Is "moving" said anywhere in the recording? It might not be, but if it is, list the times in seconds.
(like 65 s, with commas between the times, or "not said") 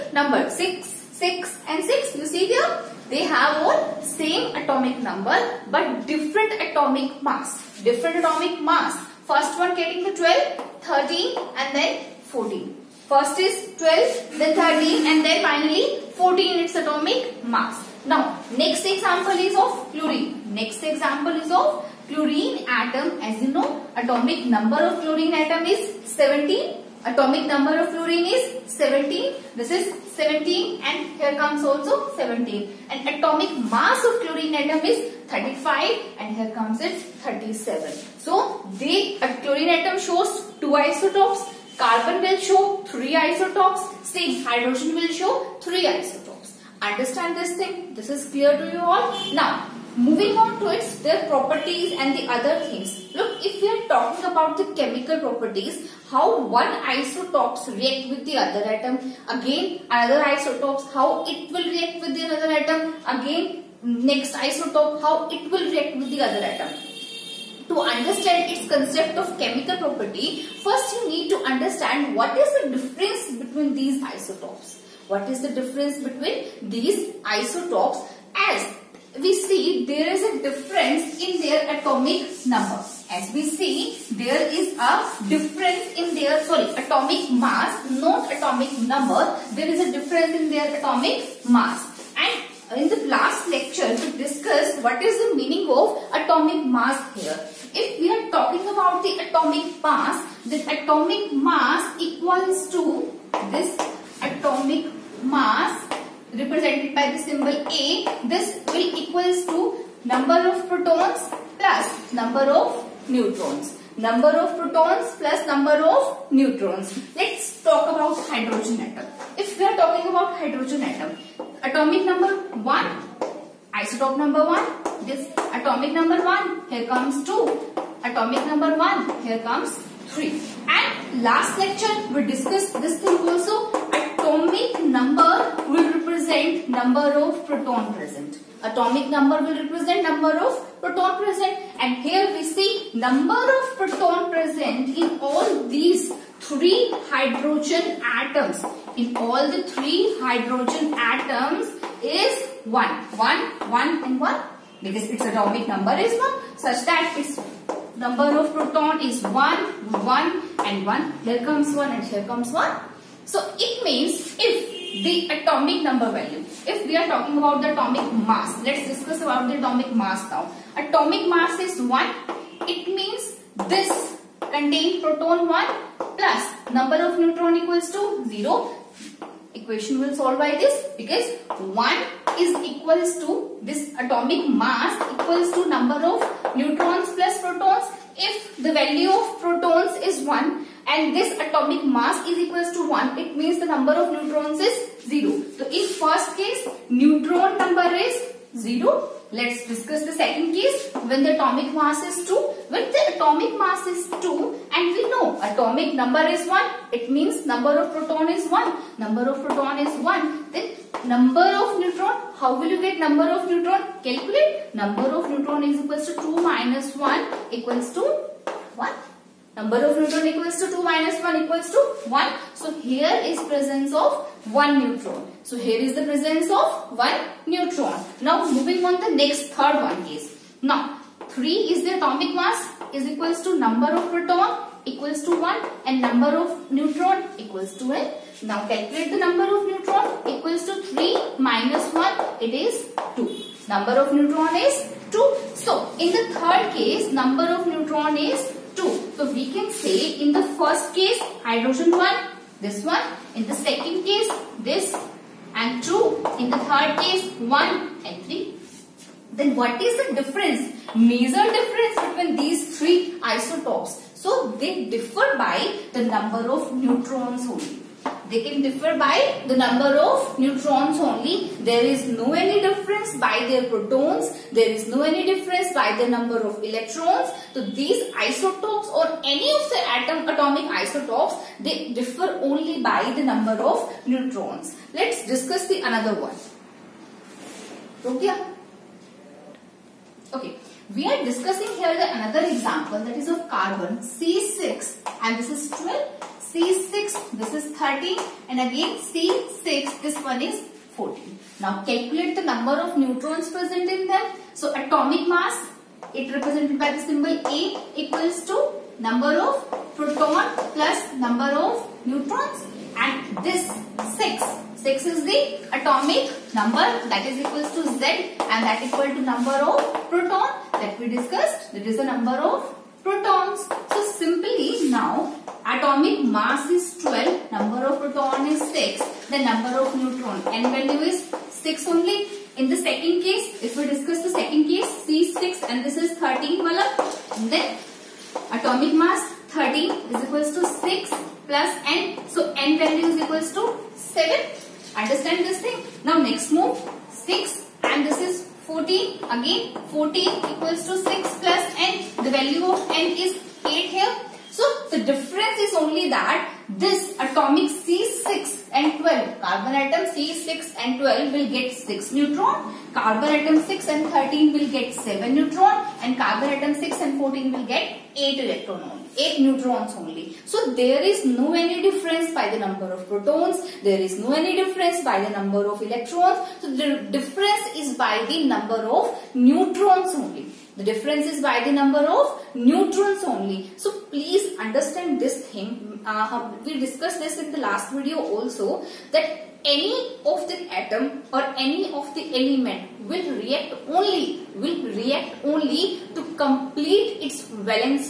49 s, 228 s.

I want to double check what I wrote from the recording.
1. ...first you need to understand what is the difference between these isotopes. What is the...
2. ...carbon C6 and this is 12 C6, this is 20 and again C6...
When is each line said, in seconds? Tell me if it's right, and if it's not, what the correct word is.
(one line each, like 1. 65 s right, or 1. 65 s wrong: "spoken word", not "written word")
1. 70 s right
2. 293 s wrong: "30", not "20".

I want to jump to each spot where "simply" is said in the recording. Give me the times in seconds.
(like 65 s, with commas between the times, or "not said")
324 s.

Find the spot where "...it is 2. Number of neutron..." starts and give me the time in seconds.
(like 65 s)
242 s.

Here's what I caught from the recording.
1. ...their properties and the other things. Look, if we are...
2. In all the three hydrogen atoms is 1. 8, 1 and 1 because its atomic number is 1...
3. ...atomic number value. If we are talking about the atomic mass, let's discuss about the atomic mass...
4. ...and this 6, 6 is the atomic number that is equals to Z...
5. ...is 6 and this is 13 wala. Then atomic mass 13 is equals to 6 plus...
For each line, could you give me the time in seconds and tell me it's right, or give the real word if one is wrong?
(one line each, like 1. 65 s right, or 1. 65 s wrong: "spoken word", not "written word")
1. 51 s right
2. 148 s wrong: "1", not "8"
3. 165 s right
4. 312 s right
5. 335 s right.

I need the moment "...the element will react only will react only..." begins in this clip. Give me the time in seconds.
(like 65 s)
392 s.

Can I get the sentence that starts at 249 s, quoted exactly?
So we can say in the first case hydrogen 1, this one.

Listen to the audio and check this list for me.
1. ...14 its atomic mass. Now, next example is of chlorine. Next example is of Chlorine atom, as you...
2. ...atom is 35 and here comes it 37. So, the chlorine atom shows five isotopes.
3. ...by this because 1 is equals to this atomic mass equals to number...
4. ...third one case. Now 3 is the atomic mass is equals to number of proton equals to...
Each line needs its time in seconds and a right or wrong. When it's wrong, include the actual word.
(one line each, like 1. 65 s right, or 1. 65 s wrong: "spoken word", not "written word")
1. 16 s right
2. 34 s wrong: "two", not "five"
3. 180 s right
4. 229 s right.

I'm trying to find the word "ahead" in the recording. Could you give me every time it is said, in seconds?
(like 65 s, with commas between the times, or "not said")
not said.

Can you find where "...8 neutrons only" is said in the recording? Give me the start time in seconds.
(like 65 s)
369 s.